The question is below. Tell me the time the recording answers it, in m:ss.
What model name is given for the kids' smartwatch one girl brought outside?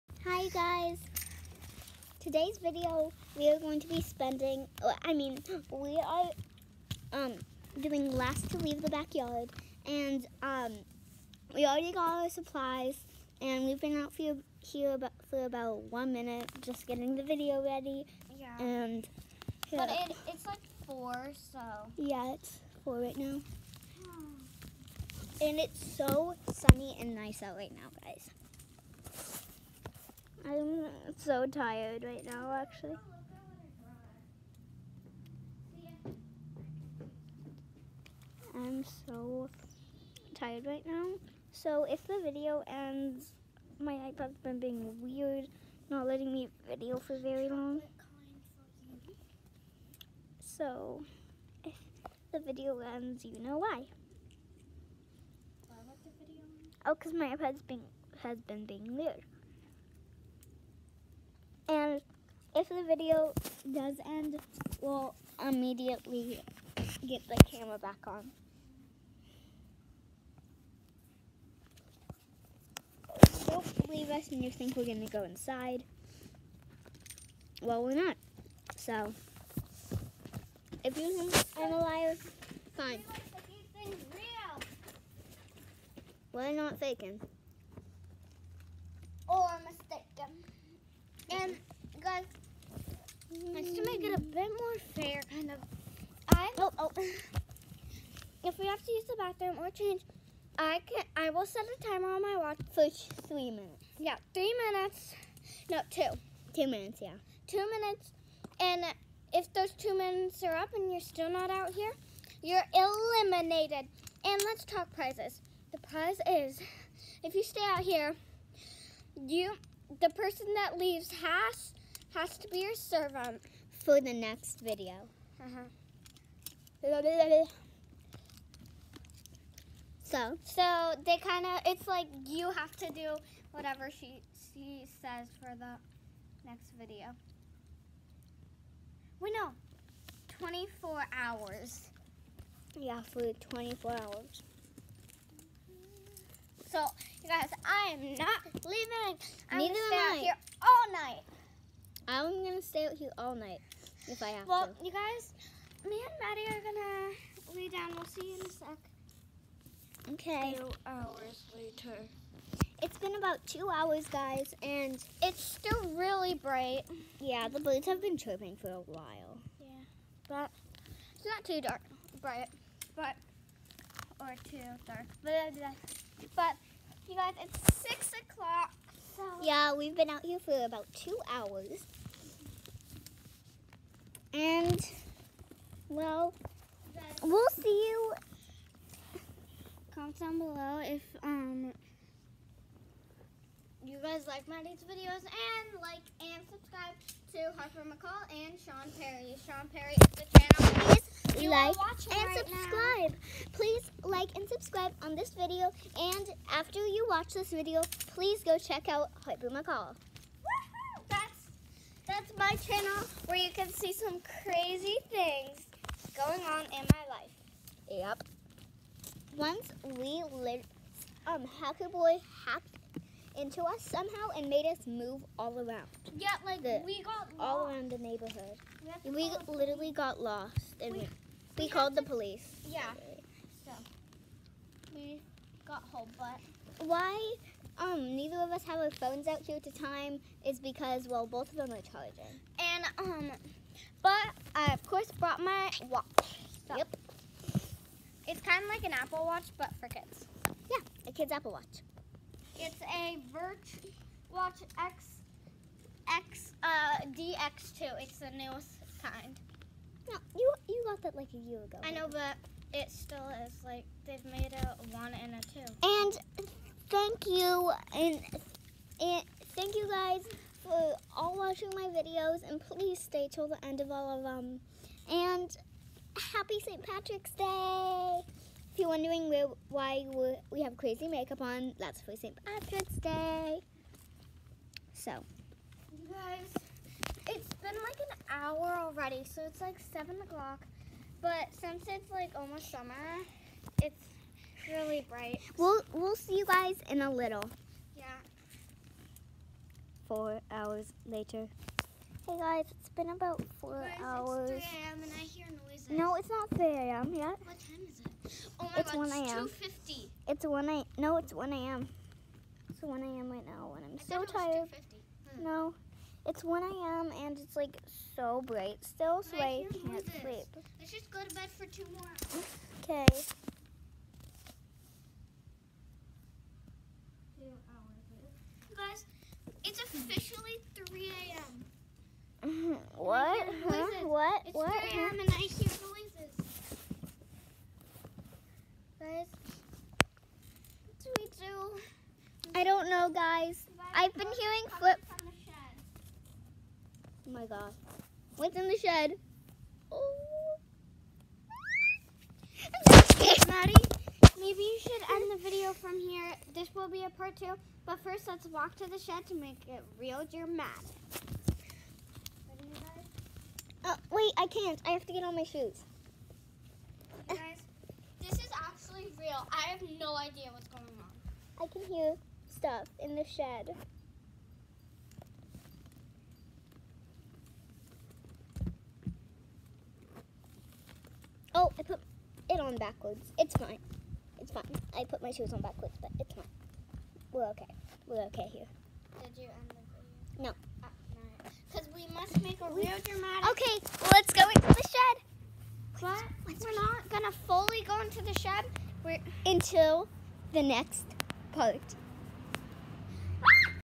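4:17.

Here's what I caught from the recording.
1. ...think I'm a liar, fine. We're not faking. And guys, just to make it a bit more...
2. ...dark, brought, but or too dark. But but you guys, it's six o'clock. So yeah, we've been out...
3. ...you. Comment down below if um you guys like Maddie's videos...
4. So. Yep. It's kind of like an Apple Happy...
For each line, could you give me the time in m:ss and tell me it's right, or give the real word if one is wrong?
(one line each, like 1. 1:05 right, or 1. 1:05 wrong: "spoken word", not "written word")
1. 1:21 right
2. 2:51 wrong: "bright", not "brought"
3. 3:07 right
4. 4:06 wrong: "Watch", not "Happy".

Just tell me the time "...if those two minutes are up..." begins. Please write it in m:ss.
1:49.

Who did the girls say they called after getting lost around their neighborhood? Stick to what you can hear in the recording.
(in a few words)
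the police.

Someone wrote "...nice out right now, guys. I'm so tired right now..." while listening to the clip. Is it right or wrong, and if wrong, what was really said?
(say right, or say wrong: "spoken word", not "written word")
right.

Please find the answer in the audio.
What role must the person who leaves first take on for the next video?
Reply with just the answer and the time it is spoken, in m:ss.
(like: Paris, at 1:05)
servant, at 2:02.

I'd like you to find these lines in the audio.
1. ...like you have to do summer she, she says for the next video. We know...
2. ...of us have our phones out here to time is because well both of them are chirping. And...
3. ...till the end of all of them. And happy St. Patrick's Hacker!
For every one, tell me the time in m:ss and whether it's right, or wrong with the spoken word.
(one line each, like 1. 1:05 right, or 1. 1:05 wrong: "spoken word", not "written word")
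1. 2:11 wrong: "whatever", not "summer"
2. 3:58 wrong: "charging", not "chirping"
3. 4:33 wrong: "Day", not "Hacker".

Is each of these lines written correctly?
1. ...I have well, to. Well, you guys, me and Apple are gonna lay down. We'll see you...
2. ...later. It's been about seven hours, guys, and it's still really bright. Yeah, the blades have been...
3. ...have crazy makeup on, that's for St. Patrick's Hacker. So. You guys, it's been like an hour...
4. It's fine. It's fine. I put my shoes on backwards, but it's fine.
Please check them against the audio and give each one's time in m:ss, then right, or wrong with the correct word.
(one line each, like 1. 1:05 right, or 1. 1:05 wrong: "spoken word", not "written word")
1. 2:34 wrong: "Maddie", not "Apple"
2. 2:41 wrong: "two", not "seven"
3. 4:40 wrong: "Day", not "Hacker"
4. 6:23 right.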